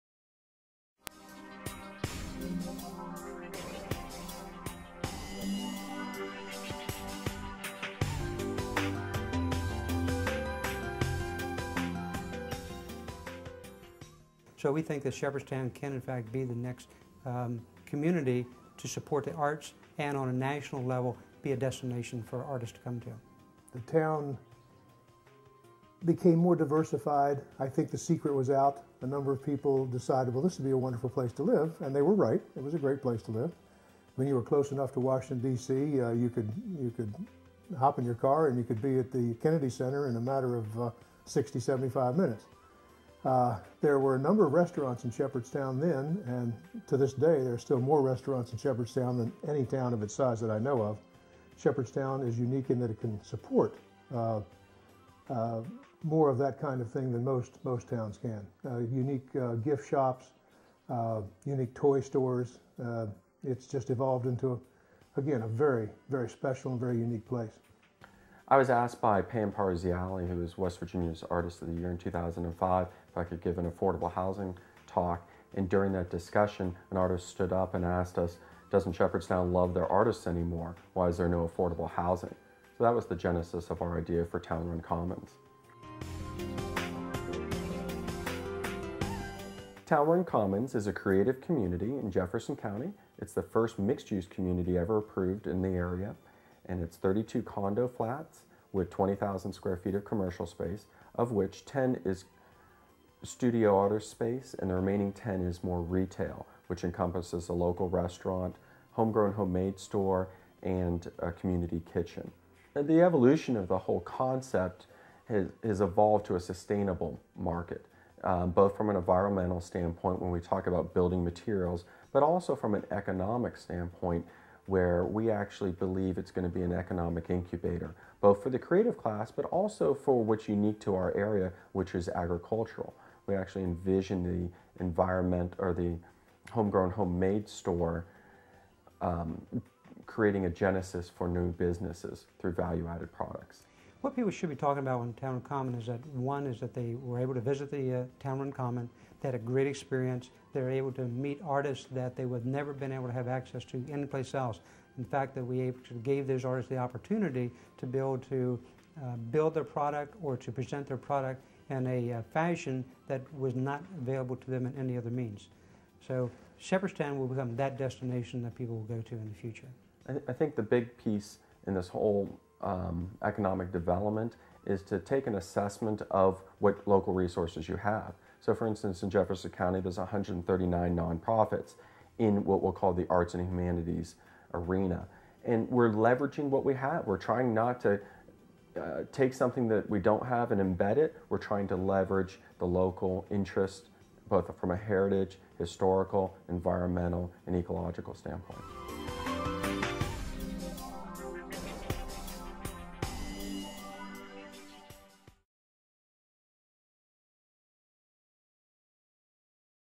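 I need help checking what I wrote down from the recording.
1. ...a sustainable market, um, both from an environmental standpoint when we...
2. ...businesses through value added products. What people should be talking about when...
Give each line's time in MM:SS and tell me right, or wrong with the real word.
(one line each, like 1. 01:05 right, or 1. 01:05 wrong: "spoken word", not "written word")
1. 01:56 right
2. 02:21 right.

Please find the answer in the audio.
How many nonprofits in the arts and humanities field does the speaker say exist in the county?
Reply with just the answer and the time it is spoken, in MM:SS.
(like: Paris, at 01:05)
139, at 02:59.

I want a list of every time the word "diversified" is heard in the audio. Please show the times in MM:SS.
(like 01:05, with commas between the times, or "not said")
00:26.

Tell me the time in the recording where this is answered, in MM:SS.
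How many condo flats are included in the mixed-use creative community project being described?
01:36.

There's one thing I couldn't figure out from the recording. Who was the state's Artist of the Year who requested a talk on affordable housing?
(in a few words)
Pam Parziale.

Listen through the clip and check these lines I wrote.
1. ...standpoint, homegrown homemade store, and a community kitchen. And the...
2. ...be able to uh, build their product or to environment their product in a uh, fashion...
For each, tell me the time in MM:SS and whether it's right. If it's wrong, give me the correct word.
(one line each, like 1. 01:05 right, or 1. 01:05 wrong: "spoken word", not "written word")
1. 01:47 wrong: "restaurant", not "standpoint"
2. 02:37 wrong: "present", not "environment".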